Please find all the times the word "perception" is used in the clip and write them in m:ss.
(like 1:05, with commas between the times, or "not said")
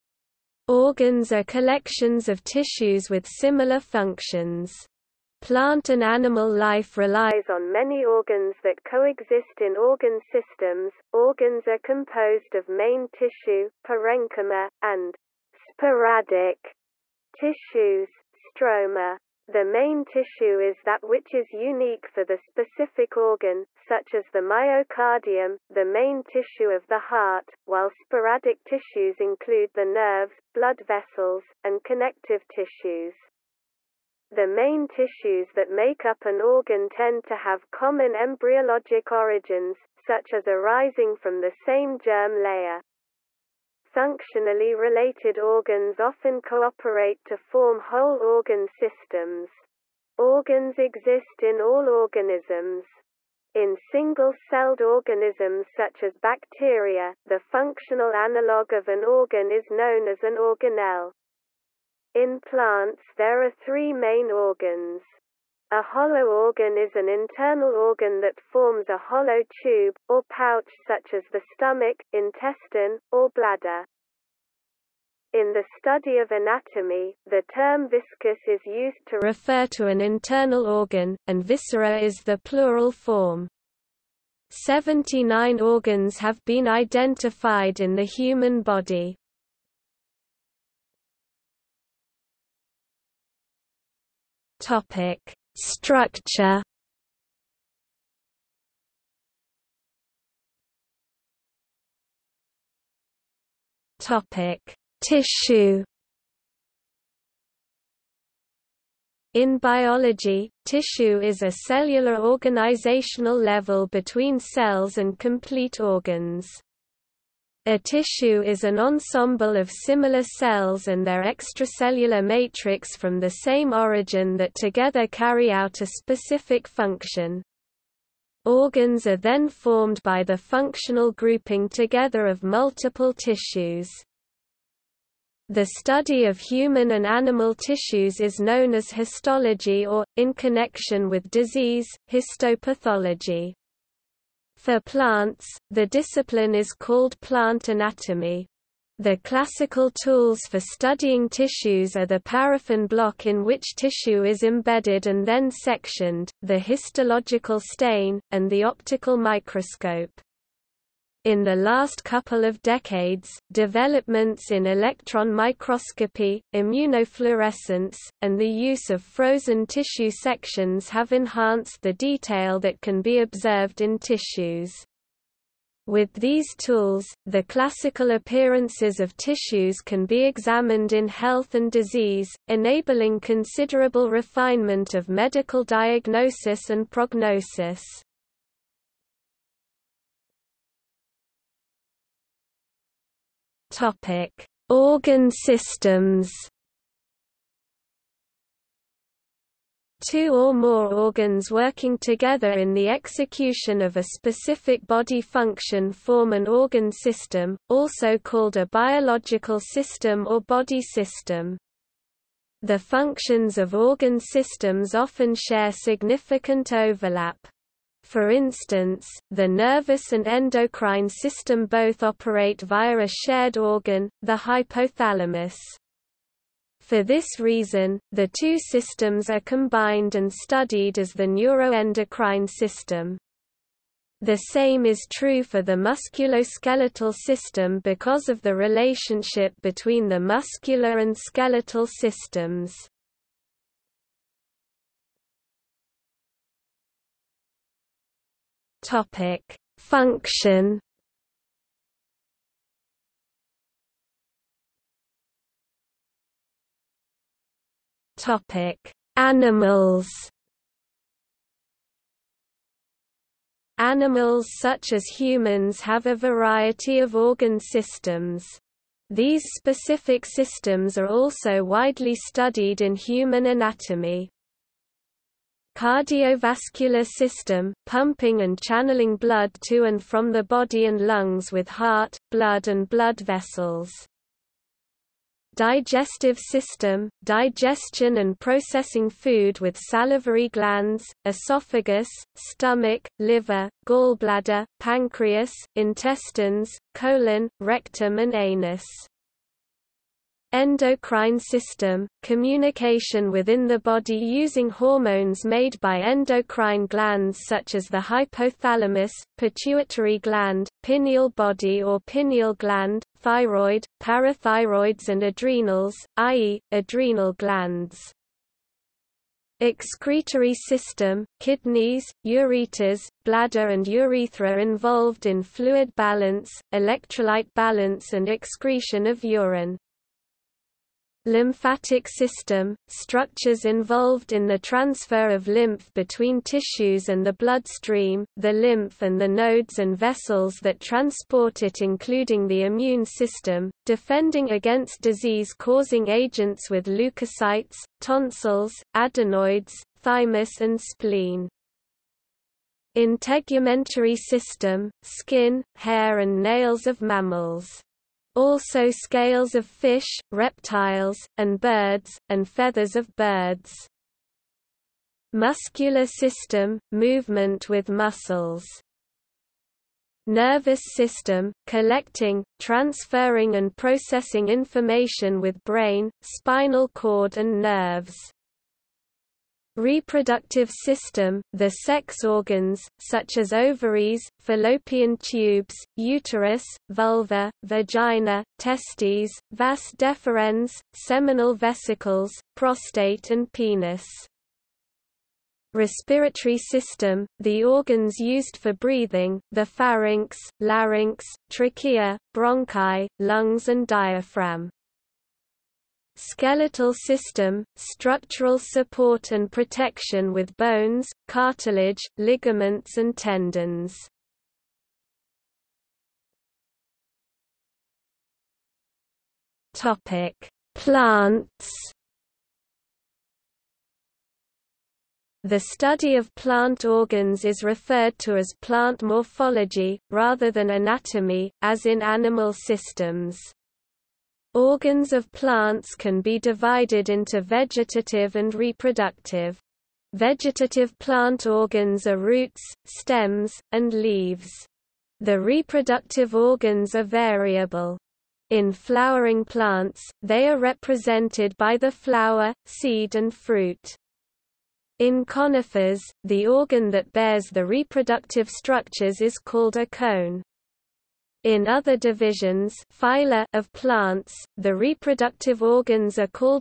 not said.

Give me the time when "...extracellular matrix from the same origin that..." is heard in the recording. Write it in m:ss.
2:01.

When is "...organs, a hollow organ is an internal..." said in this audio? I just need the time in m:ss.
1:04.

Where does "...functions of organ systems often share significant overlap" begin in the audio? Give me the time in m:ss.
3:32.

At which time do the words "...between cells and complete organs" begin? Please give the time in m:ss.
1:53.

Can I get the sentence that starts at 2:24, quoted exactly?
For plants, the discipline is called plant anatomy.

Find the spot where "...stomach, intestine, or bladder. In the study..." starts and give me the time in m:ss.
1:11.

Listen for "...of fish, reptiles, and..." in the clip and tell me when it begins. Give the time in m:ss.
5:59.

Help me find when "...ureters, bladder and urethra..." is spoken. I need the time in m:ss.
5:22.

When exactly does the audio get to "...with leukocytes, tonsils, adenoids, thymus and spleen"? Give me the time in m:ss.
5:46.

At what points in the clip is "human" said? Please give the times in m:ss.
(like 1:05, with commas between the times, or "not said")
1:28, 2:16, 4:25, 4:32.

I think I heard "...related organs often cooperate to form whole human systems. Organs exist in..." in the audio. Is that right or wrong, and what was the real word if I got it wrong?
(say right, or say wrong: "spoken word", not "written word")
wrong: "organ", not "human".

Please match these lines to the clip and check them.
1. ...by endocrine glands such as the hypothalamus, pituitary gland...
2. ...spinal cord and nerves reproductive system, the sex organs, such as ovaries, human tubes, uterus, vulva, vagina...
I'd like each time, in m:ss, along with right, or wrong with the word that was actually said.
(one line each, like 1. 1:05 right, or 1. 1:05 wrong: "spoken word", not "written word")
1. 5:05 right
2. 6:16 wrong: "fallopian", not "human".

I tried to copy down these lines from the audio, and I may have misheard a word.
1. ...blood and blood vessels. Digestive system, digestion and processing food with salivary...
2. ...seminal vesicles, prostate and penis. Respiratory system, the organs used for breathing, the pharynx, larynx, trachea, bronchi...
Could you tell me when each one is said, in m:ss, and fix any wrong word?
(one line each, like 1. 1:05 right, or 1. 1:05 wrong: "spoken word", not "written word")
1. 4:42 right
2. 6:30 right.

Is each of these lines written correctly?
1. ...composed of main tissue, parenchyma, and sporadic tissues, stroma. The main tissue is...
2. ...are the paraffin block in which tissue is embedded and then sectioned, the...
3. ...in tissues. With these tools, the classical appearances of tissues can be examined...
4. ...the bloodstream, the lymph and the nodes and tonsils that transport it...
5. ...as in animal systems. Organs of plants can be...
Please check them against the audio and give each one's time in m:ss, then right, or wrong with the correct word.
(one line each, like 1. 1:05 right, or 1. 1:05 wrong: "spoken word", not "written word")
1. 0:11 right
2. 2:31 right
3. 2:53 right
4. 5:37 wrong: "vessels", not "tonsils"
5. 7:11 right.